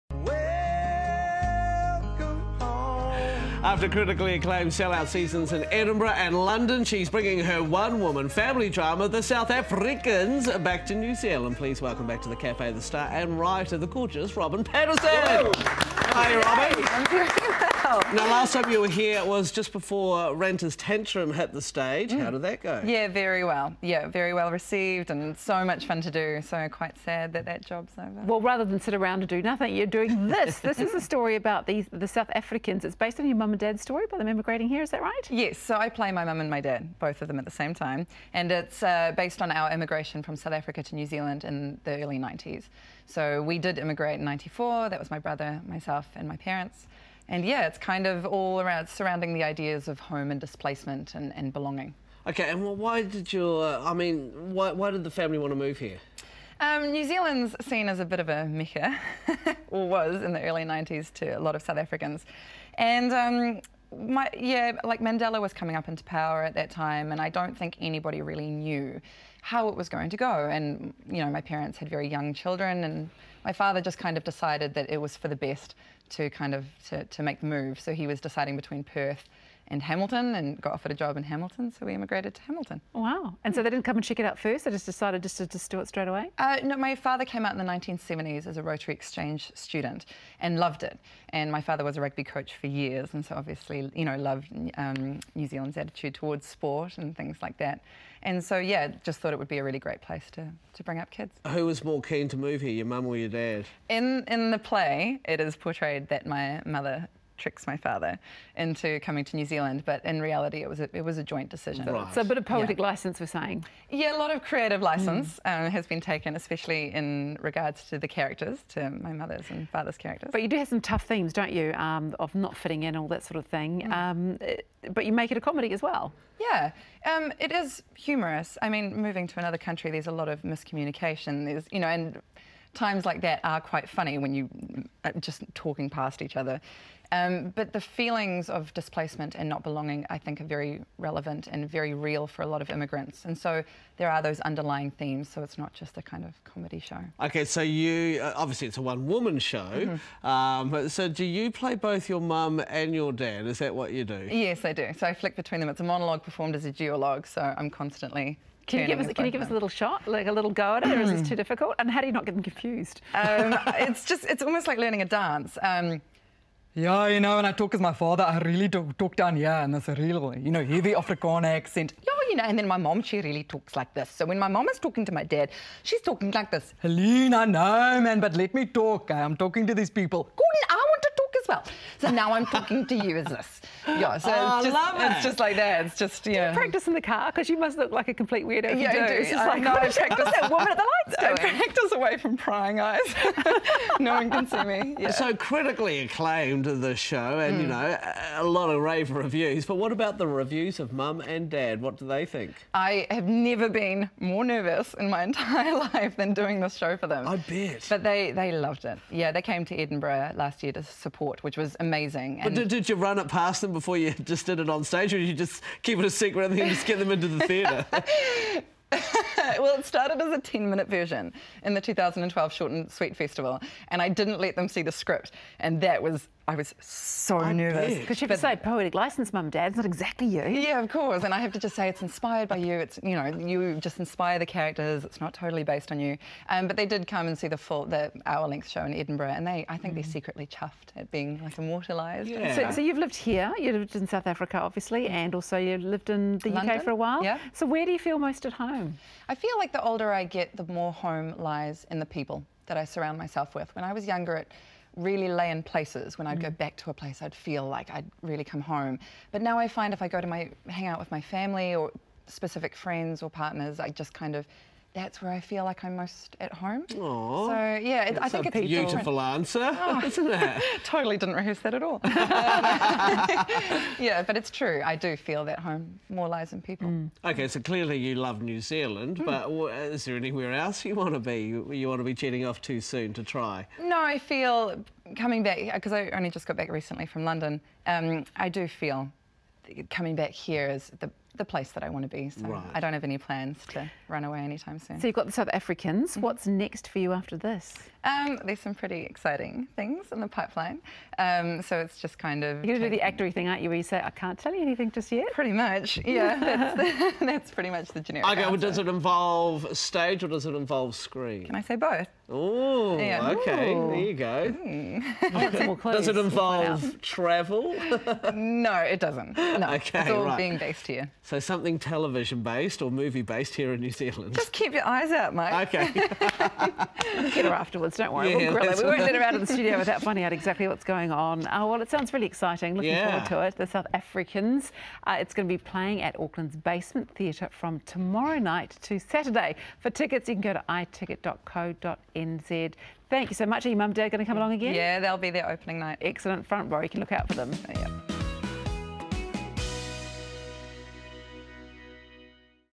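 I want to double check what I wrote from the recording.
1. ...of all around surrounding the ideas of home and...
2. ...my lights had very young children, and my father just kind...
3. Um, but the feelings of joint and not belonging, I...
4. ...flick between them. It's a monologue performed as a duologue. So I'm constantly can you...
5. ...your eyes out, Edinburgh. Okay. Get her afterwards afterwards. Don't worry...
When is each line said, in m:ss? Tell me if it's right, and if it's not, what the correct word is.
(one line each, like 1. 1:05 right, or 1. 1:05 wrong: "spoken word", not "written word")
1. 0:48 right
2. 1:11 wrong: "parents", not "lights"
3. 2:17 wrong: "displacement", not "joint"
4. 2:35 right
5. 5:24 wrong: "Mike", not "Edinburgh".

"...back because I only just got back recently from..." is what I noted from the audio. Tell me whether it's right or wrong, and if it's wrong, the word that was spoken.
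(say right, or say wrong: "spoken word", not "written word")
right.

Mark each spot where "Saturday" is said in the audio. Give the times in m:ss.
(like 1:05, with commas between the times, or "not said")
5:38.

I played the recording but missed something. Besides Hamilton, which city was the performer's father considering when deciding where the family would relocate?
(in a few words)
Perth.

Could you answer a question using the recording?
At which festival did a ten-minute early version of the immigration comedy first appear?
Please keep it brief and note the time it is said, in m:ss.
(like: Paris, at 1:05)
Short and Sweet Festival, at 3:42.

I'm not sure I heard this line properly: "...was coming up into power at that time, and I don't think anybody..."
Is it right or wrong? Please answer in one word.
right.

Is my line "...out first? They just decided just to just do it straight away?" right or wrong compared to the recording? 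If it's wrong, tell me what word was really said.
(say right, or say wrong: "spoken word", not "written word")
right.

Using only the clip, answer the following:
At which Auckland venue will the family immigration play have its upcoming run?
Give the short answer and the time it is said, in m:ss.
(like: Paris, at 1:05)
Basement Theatre, at 5:36.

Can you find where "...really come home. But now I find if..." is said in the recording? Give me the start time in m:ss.
4:18.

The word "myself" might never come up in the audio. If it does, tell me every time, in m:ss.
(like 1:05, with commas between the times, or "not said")
0:45, 4:13.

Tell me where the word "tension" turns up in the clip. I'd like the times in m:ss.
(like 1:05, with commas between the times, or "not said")
not said.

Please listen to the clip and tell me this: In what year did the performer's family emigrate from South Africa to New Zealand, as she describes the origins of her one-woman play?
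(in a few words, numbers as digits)
1994.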